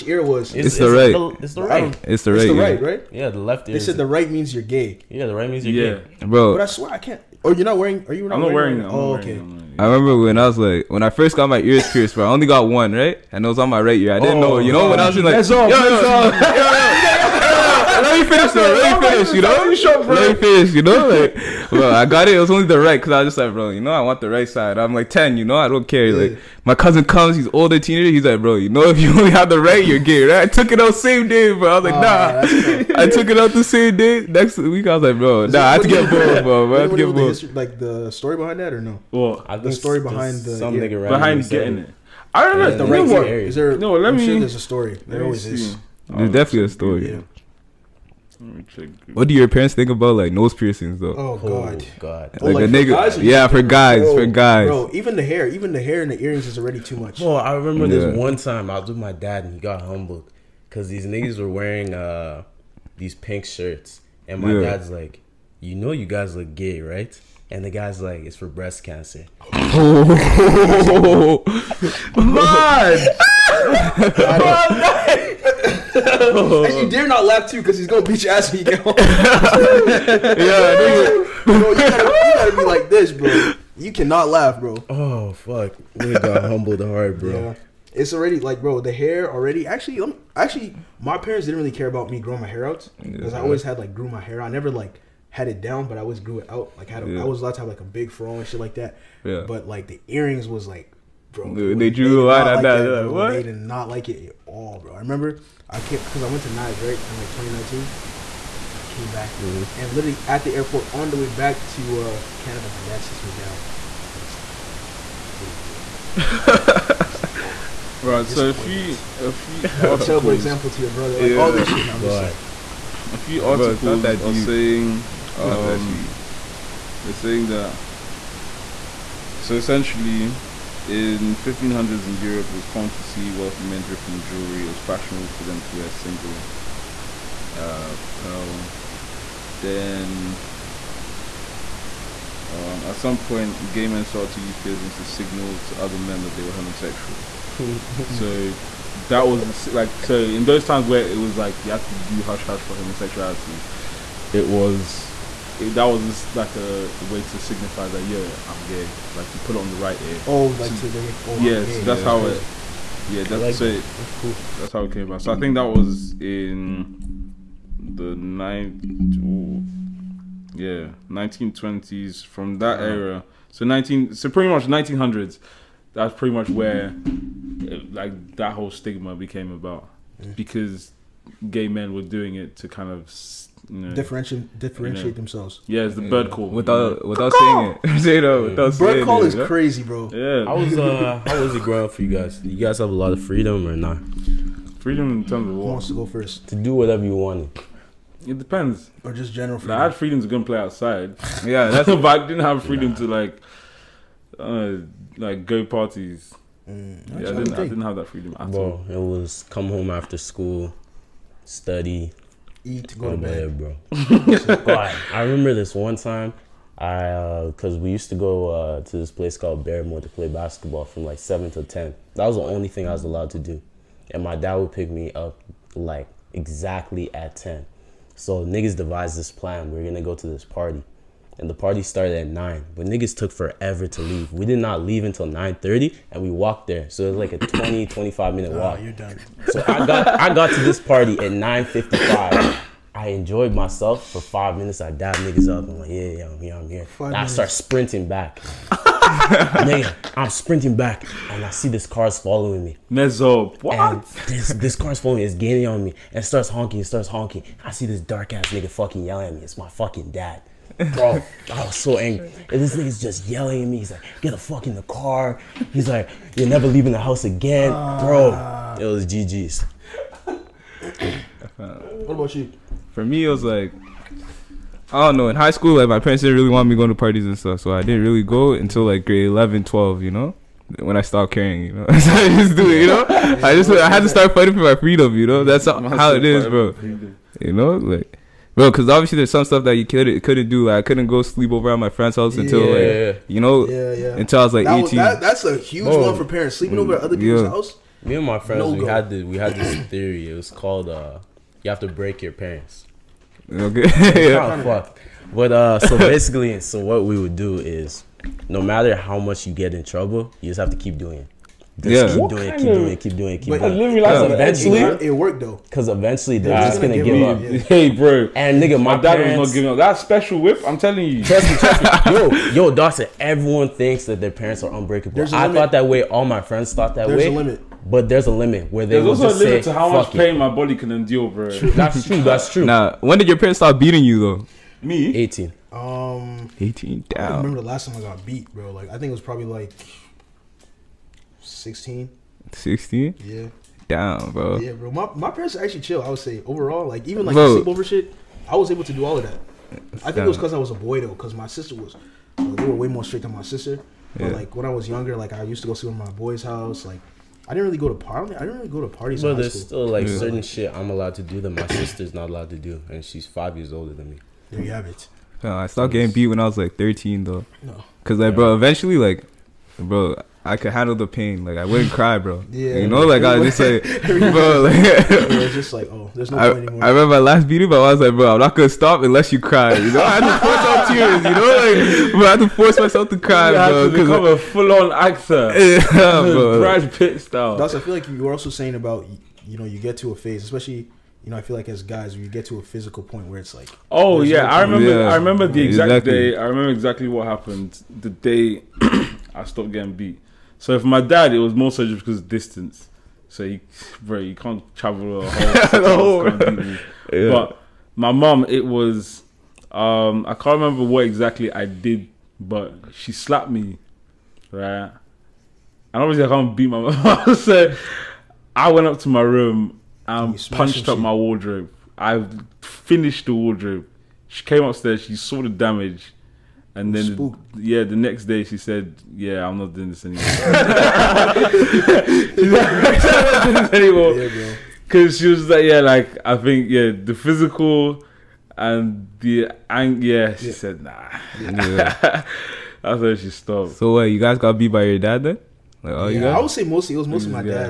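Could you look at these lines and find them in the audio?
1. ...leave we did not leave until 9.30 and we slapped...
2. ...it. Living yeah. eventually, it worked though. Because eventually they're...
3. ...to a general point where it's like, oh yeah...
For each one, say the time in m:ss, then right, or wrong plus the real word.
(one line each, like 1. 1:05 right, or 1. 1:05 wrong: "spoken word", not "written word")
1. 3:54 wrong: "walked", not "slapped"
2. 5:13 right
3. 6:32 wrong: "physical", not "general".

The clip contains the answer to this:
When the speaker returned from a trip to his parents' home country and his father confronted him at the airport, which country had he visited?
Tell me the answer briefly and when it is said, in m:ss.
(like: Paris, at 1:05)
Nigeria, at 1:46.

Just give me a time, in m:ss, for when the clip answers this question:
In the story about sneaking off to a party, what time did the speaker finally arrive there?
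4:01.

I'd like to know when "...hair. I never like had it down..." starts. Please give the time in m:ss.
1:34.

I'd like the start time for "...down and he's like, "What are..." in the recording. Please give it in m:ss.
1:53.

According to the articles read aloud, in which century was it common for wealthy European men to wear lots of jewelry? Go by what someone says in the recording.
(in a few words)
1500s.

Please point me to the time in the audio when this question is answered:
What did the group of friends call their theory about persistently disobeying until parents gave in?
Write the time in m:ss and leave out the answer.
5:01.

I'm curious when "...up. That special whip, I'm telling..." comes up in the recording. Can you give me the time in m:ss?
5:19.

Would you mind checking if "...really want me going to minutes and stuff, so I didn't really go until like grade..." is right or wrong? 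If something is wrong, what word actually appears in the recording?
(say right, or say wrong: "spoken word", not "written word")
wrong: "parties", not "minutes".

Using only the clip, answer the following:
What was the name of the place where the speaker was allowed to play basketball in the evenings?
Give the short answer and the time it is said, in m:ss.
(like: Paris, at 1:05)
Barrymore, at 3:39.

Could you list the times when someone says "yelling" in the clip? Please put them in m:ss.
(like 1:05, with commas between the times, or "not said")
4:19, 4:23.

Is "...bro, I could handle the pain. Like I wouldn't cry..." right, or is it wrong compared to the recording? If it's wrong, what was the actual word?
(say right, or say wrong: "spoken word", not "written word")
right.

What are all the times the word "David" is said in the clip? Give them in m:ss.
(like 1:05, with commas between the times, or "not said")
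not said.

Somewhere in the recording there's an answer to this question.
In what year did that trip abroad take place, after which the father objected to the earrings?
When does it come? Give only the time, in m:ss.
1:47.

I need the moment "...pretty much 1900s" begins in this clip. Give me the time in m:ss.
2:54.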